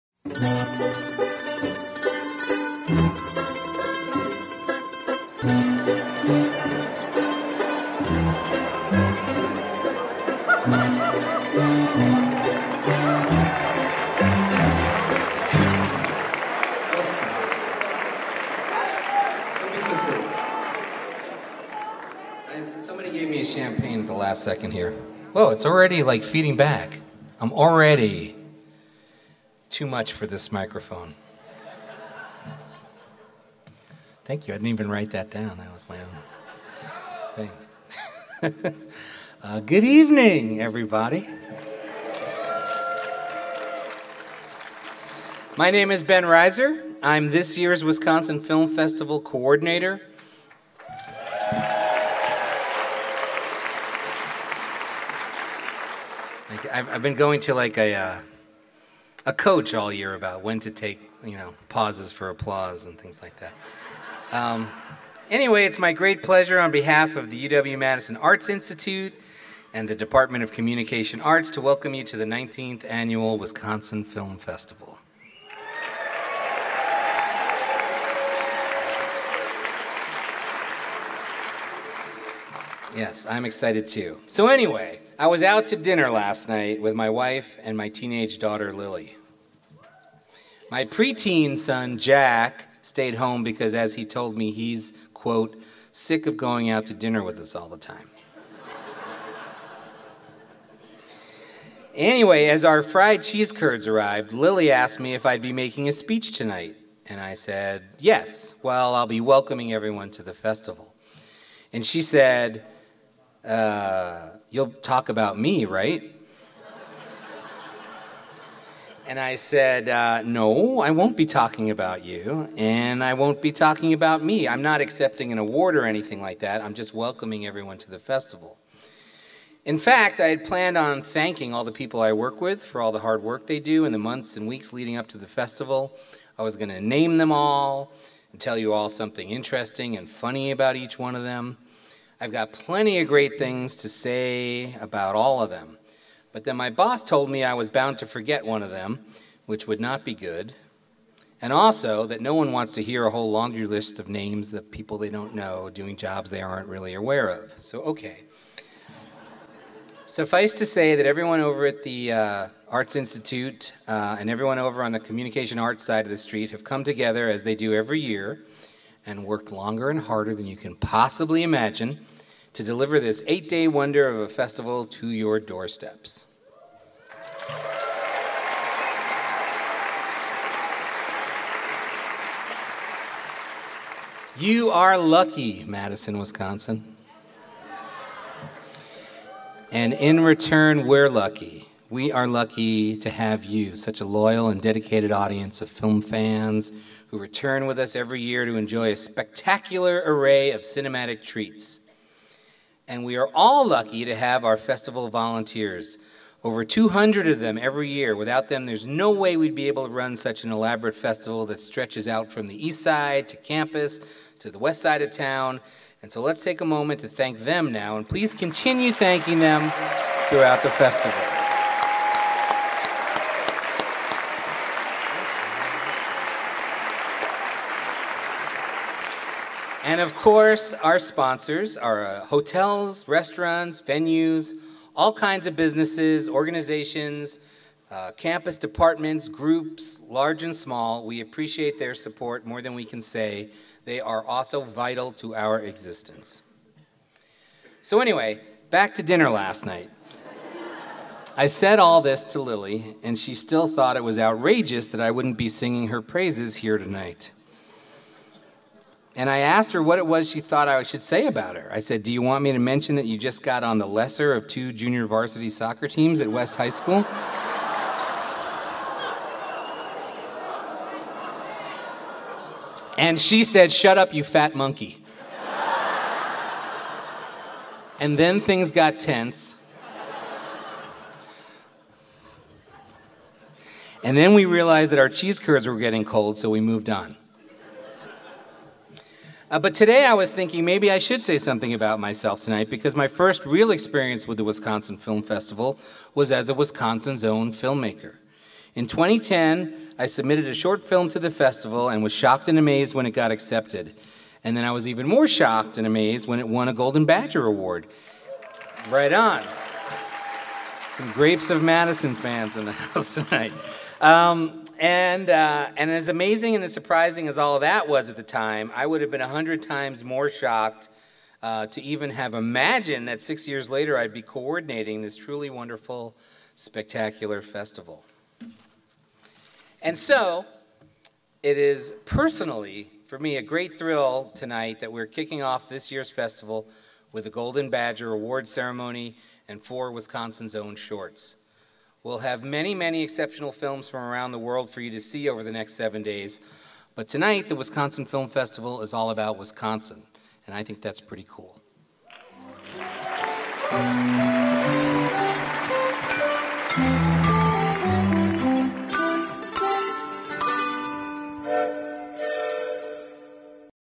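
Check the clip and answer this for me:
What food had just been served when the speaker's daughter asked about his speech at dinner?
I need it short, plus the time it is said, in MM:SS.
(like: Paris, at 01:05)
fried cheese curds, at 01:42.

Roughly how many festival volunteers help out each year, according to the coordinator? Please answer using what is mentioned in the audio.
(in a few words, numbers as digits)
over 200.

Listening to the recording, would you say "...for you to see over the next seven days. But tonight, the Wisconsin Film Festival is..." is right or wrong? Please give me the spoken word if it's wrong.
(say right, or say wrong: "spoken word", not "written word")
right.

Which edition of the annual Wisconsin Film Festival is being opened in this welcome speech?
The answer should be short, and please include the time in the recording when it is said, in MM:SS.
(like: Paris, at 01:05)
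19th, at 01:12.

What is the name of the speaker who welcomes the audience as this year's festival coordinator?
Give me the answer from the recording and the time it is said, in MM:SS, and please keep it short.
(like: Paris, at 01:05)
Ben Reiser, at 00:46.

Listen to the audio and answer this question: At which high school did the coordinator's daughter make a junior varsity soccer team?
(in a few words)
West High School.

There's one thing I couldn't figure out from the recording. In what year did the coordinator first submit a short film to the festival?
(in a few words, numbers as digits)
2010.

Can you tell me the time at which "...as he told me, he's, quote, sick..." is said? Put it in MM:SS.
01:33.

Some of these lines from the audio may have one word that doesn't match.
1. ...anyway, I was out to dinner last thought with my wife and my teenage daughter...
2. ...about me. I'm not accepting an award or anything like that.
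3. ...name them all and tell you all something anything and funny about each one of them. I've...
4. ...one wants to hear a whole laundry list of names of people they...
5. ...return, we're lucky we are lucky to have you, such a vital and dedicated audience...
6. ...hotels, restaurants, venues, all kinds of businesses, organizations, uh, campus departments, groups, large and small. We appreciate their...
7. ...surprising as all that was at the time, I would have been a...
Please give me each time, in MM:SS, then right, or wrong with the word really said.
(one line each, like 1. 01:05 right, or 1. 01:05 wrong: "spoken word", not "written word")
1. 01:24 wrong: "night", not "thought"
2. 02:03 right
3. 02:16 wrong: "interesting", not "anything"
4. 02:32 right
5. 03:10 wrong: "loyal", not "vital"
6. 03:52 right
7. 05:16 right.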